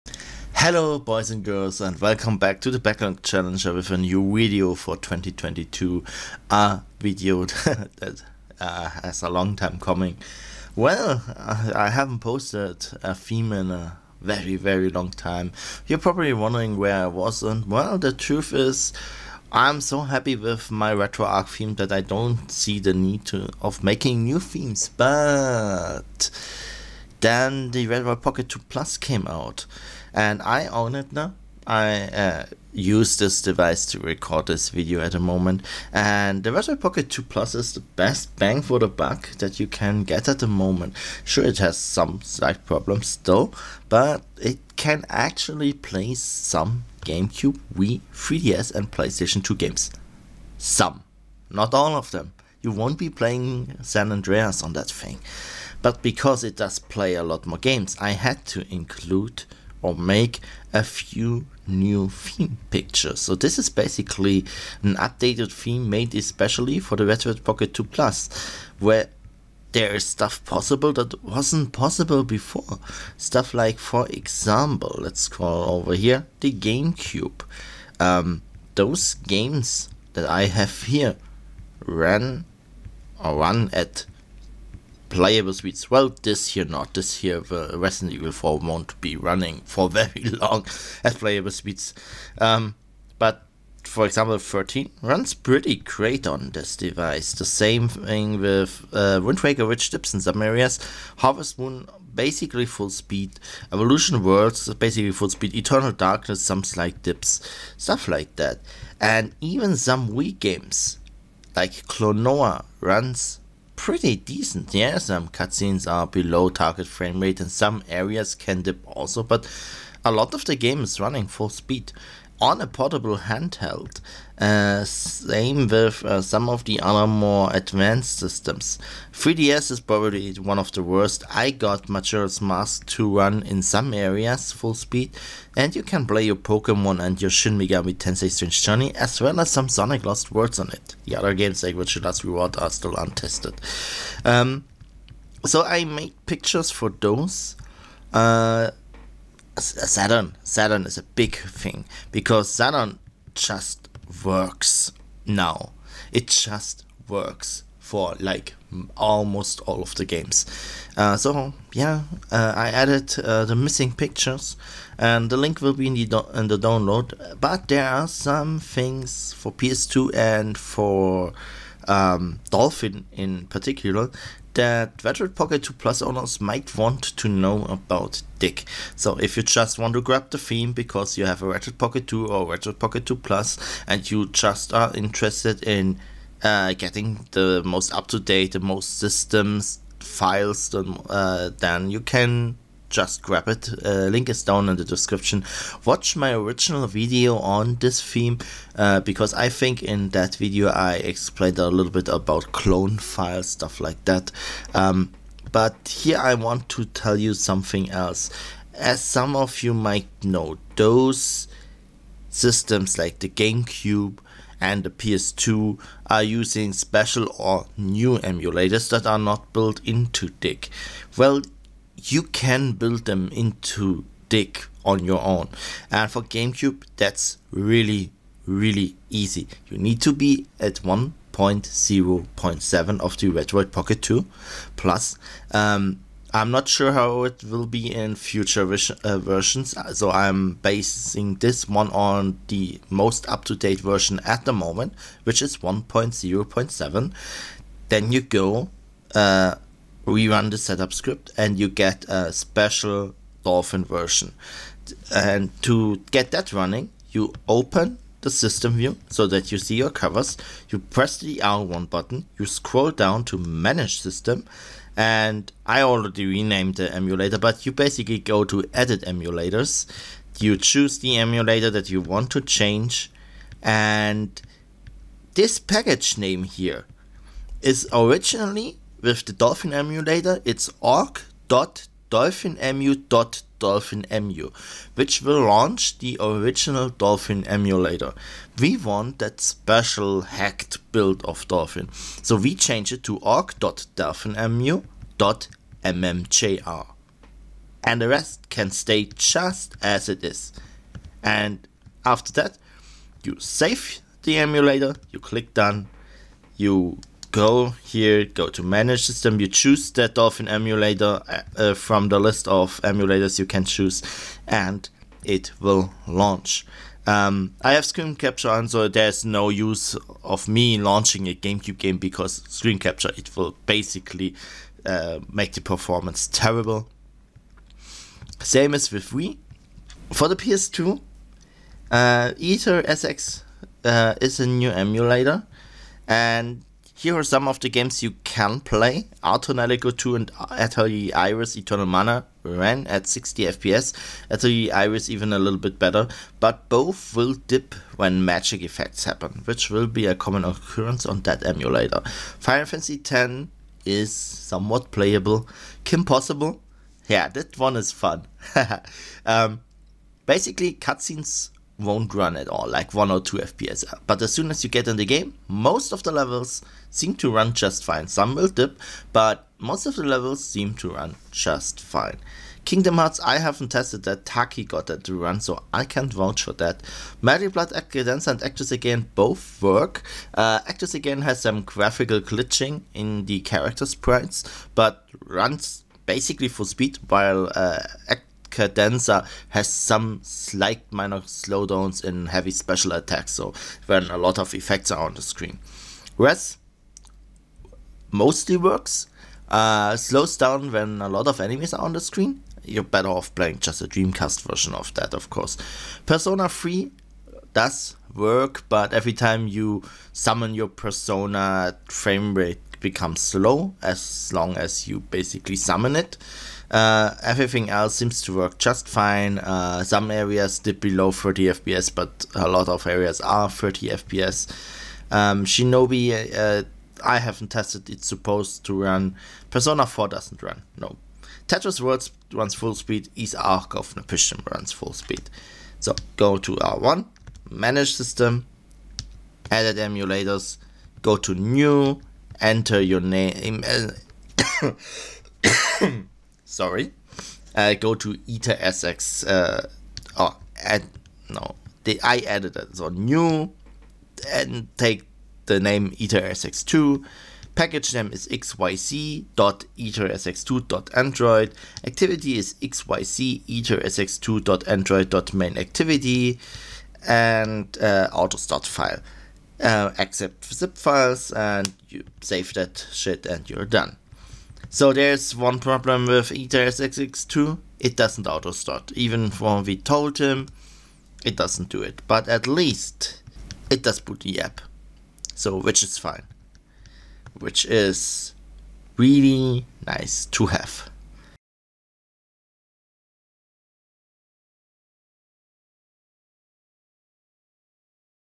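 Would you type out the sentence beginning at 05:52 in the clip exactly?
Final Fantasy Ten is somewhat playable.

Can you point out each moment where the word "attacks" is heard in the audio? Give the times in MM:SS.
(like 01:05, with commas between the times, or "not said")
06:32.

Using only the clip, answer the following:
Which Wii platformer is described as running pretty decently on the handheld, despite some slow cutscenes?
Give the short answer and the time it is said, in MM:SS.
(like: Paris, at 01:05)
Klonoa, at 01:51.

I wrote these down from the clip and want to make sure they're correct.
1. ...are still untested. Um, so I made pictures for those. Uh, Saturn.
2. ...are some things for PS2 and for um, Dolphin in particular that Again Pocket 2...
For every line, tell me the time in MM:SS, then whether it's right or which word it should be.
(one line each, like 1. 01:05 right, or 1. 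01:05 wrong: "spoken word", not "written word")
1. 02:22 right
2. 02:47 wrong: "Retroid", not "Again".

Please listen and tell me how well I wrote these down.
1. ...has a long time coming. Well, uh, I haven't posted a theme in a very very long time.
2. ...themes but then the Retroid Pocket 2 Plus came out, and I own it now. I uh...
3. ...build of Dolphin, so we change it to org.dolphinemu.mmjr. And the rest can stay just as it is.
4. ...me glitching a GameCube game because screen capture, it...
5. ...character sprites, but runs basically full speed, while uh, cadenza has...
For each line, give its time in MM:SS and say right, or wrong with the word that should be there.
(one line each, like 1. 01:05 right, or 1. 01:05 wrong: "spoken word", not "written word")
1. 00:09 right
2. 00:24 right
3. 04:50 right
4. 05:20 wrong: "launching", not "glitching"
5. 06:23 right.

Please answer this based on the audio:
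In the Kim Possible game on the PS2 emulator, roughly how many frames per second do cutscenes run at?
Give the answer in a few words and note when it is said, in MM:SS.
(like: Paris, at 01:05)
1 or 2 FPS, at 06:02.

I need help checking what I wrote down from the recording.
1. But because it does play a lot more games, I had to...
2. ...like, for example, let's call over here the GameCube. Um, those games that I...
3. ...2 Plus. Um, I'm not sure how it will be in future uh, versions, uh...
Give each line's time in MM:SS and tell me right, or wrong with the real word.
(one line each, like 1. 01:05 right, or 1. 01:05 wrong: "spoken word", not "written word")
1. 00:55 right
2. 01:13 right
3. 03:54 right.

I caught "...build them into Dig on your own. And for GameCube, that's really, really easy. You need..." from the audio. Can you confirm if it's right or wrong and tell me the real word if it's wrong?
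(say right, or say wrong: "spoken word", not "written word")
right.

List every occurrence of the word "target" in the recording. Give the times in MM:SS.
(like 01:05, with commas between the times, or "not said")
01:56.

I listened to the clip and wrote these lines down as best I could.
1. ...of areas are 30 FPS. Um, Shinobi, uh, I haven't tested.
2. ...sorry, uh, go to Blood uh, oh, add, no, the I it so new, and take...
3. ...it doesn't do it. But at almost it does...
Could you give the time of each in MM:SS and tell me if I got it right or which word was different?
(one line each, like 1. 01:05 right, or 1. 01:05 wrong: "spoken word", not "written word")
1. 07:02 right
2. 07:26 wrong: "AetherSX", not "Blood"
3. 08:01 wrong: "least", not "almost".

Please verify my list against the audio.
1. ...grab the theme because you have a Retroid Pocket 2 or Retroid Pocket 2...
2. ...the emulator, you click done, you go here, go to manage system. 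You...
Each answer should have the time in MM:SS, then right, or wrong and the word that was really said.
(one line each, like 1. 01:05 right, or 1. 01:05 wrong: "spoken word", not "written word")
1. 03:00 right
2. 05:04 right.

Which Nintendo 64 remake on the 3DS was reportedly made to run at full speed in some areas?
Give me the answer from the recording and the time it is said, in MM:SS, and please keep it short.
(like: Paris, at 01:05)
Majora's Mask, at 02:11.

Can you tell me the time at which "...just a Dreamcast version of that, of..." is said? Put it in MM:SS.
06:43.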